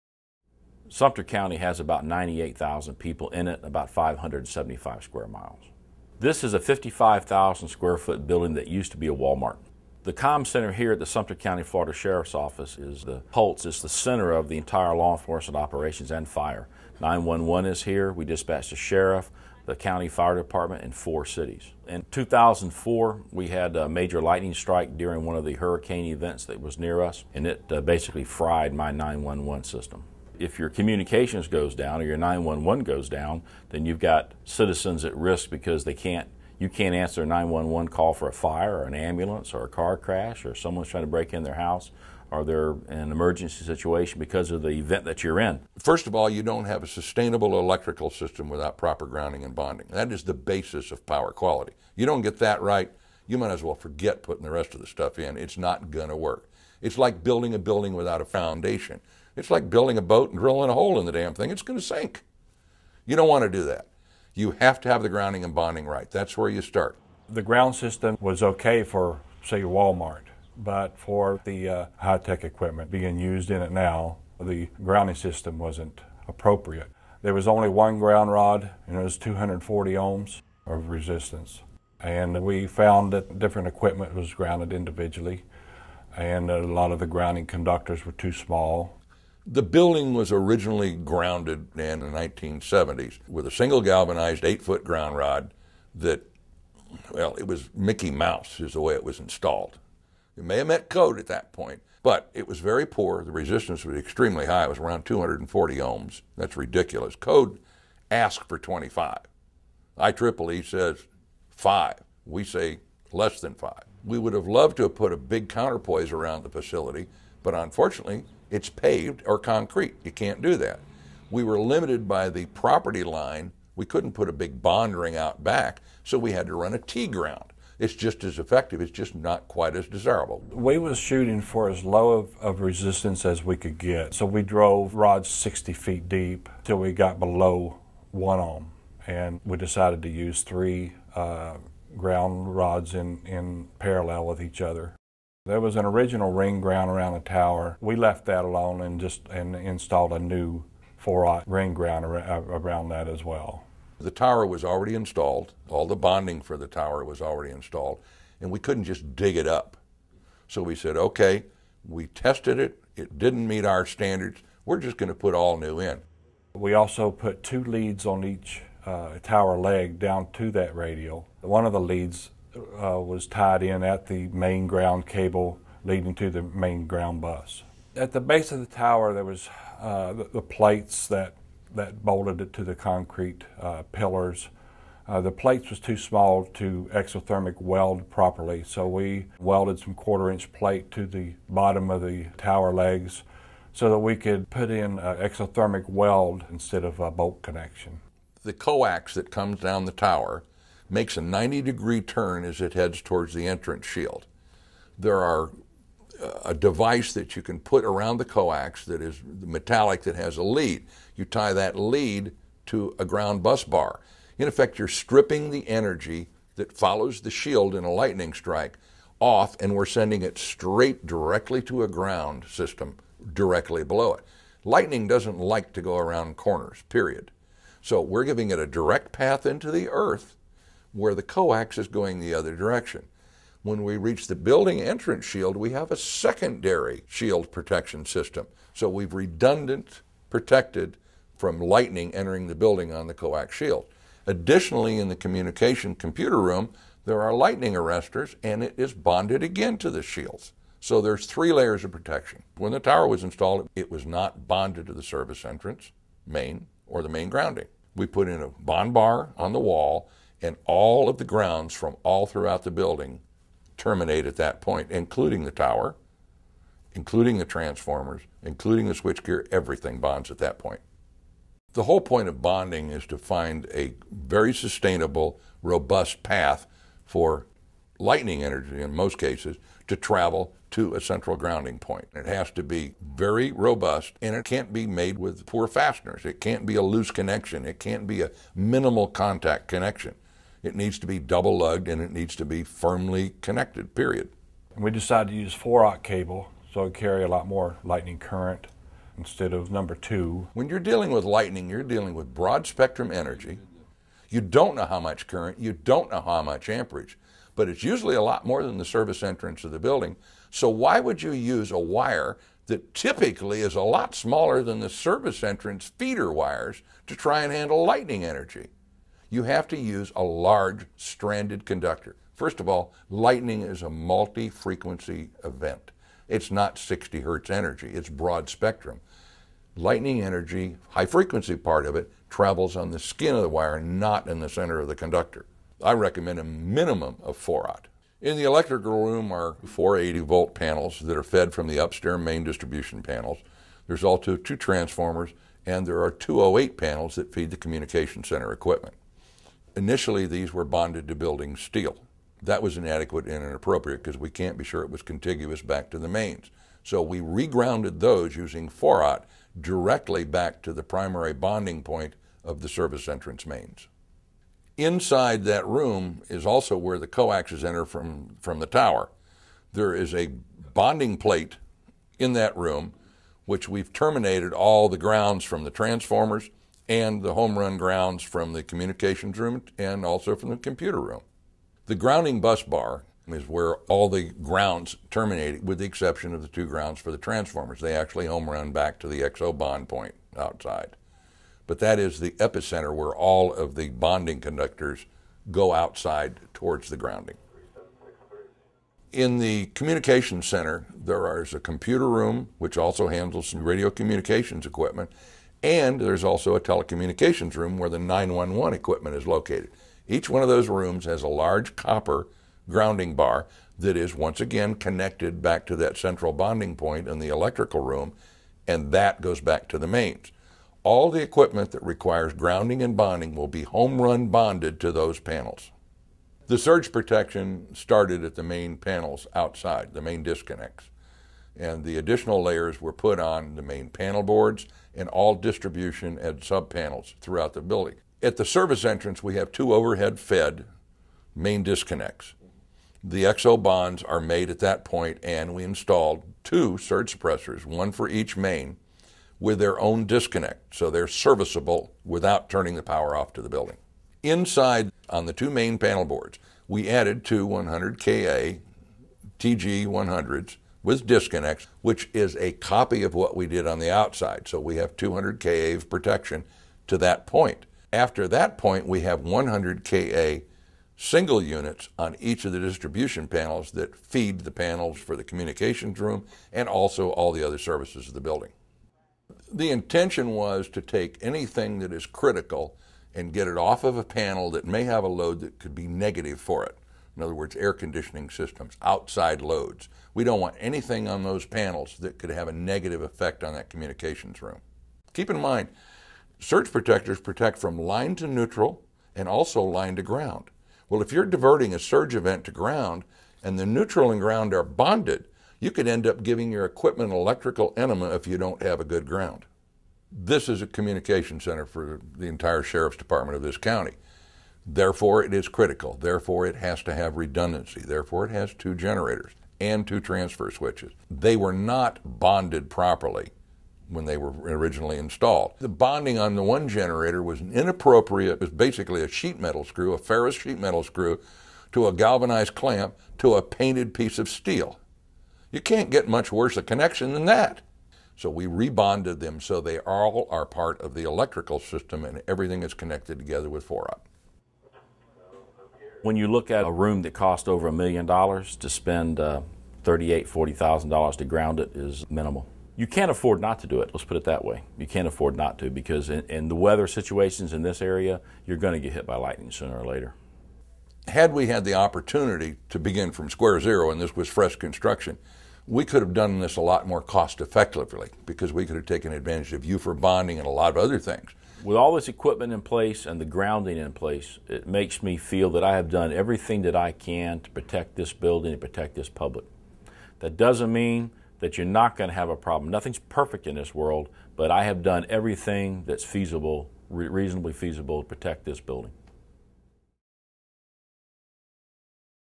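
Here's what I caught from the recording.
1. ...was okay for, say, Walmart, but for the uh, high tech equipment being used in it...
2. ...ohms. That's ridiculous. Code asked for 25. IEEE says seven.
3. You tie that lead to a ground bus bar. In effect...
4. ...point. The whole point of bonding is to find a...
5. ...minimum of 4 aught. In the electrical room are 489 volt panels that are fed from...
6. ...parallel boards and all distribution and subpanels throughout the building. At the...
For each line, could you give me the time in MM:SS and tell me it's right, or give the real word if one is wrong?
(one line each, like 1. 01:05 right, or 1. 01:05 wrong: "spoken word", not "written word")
1. 01:08 right
2. 01:45 wrong: "five", not "seven"
3. 03:31 right
4. 04:30 right
5. 05:36 wrong: "480", not "489"
6. 07:13 wrong: "panel", not "parallel".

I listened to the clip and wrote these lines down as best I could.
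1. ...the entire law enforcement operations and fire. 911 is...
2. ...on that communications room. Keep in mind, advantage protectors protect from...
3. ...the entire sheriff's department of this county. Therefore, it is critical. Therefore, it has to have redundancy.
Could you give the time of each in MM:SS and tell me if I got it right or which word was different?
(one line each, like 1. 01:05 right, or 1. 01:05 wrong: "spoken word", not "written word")
1. 00:14 right
2. 08:13 wrong: "surge", not "advantage"
3. 08:32 right.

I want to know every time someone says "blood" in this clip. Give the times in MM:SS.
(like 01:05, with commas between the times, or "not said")
not said.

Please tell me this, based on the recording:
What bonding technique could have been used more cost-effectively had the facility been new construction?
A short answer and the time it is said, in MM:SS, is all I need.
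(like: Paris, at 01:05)
Ufer bonding, at 09:29.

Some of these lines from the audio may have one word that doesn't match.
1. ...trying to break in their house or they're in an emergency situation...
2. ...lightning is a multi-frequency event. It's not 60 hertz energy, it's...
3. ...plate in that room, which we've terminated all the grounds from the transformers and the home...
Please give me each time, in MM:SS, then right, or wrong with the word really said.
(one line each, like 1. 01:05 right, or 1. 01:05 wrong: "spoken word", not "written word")
1. 00:40 right
2. 05:23 right
3. 06:11 right.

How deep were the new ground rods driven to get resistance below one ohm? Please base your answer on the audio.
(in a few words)
60 feet.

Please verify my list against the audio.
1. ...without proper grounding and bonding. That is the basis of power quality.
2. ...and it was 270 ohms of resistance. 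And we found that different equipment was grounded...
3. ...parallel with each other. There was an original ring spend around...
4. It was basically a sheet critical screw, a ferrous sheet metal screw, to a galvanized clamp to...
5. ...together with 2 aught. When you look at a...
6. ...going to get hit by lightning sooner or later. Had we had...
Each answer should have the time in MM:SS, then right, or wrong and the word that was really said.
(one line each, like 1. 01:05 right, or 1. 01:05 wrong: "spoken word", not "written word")
1. 00:48 right
2. 01:18 wrong: "240", not "270"
3. 02:23 wrong: "ground", not "spend"
4. 08:48 wrong: "metal", not "critical"
5. 09:03 wrong: "4", not "2"
6. 09:18 right.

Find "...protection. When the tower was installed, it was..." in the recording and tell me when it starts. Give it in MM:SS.
04:11.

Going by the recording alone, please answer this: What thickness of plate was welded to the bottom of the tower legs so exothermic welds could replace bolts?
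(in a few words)
quarter-inch.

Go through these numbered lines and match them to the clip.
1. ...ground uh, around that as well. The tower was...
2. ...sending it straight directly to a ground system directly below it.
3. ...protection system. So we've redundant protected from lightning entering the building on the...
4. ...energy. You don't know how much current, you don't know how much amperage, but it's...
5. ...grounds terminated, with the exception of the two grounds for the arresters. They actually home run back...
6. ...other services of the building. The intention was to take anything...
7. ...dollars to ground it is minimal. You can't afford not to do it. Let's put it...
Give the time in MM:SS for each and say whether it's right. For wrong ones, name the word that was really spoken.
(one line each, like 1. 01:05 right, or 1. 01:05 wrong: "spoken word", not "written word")
1. 02:31 right
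2. 03:39 right
3. 03:57 right
4. 05:03 right
5. 06:24 wrong: "transformers", not "arresters"
6. 07:57 right
7. 09:10 right.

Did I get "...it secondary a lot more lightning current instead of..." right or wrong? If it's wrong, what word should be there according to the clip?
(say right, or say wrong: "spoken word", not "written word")
wrong: "carry", not "secondary".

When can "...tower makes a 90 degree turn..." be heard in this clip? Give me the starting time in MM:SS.
03:19.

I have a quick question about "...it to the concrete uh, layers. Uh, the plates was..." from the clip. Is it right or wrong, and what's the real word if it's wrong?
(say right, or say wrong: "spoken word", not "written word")
wrong: "pillars", not "layers".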